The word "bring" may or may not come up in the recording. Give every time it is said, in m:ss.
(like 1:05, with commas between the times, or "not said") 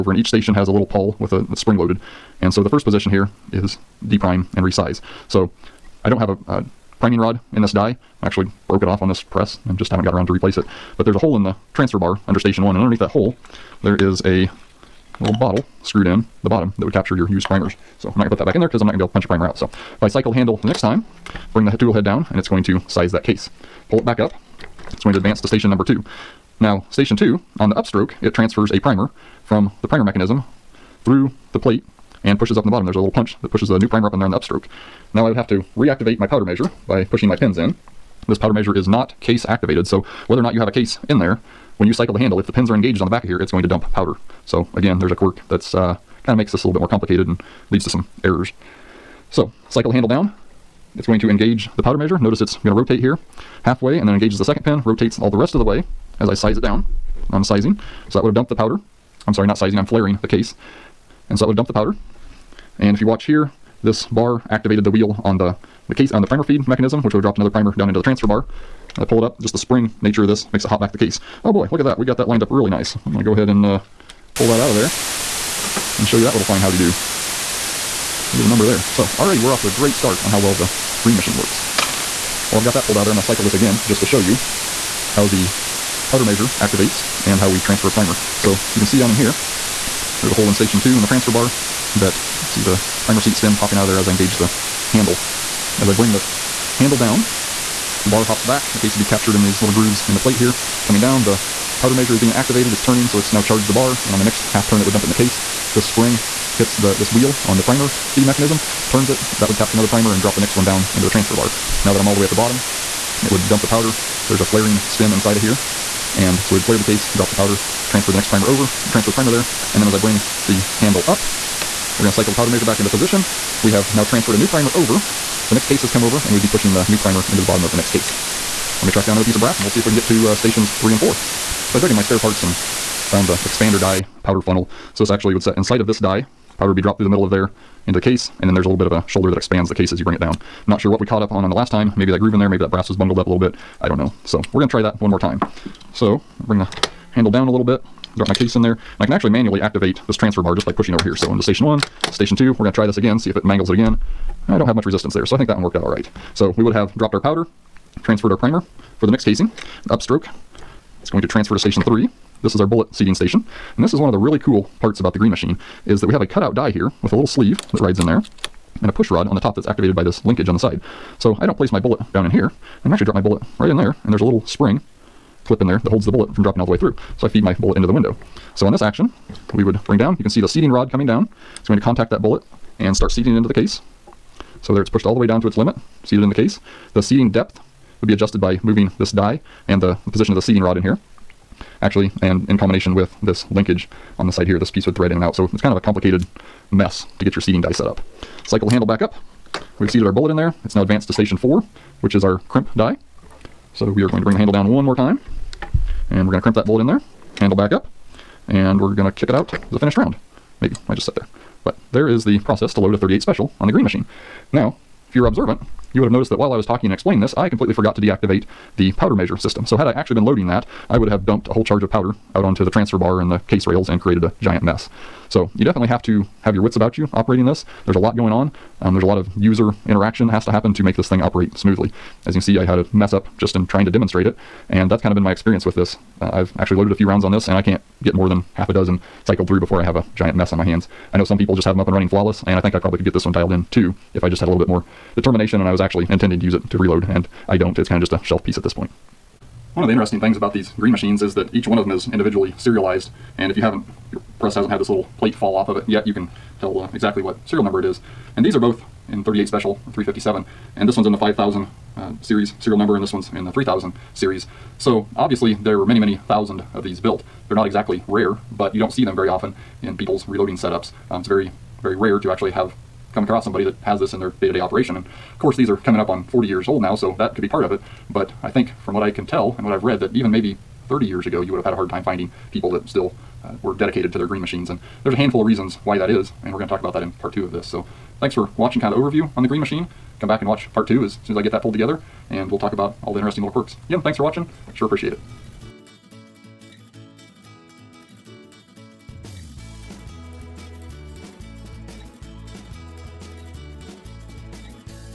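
0:21, 1:35, 1:59, 2:20, 2:26, 2:59, 3:24.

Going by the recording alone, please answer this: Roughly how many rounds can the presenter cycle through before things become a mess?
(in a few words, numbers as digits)
Half a dozen.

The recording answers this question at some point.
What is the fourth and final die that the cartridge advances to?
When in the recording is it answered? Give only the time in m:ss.
3:22.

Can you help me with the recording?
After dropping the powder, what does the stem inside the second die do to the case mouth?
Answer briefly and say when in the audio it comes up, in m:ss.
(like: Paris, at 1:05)
Flare the case, at 1:56.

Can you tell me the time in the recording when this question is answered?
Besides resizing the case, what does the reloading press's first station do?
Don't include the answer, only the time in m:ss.
0:04.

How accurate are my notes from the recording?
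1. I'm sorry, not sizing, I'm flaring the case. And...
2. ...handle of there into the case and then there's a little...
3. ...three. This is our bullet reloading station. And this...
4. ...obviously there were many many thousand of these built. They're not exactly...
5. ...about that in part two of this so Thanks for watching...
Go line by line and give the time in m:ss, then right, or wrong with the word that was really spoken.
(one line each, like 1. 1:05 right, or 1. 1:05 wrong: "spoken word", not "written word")
1. 0:59 right
2. 2:17 wrong: "middle", not "handle"
3. 2:41 wrong: "seating", not "reloading"
4. 4:25 right
5. 4:46 right.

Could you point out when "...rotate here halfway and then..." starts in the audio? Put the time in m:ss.
0:52.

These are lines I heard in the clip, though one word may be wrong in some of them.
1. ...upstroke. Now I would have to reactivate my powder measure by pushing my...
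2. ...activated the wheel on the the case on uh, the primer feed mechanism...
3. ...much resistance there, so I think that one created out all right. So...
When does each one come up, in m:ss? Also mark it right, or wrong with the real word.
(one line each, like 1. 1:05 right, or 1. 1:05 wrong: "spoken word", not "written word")
1. 0:34 right
2. 1:04 right
3. 2:34 wrong: "worked", not "created".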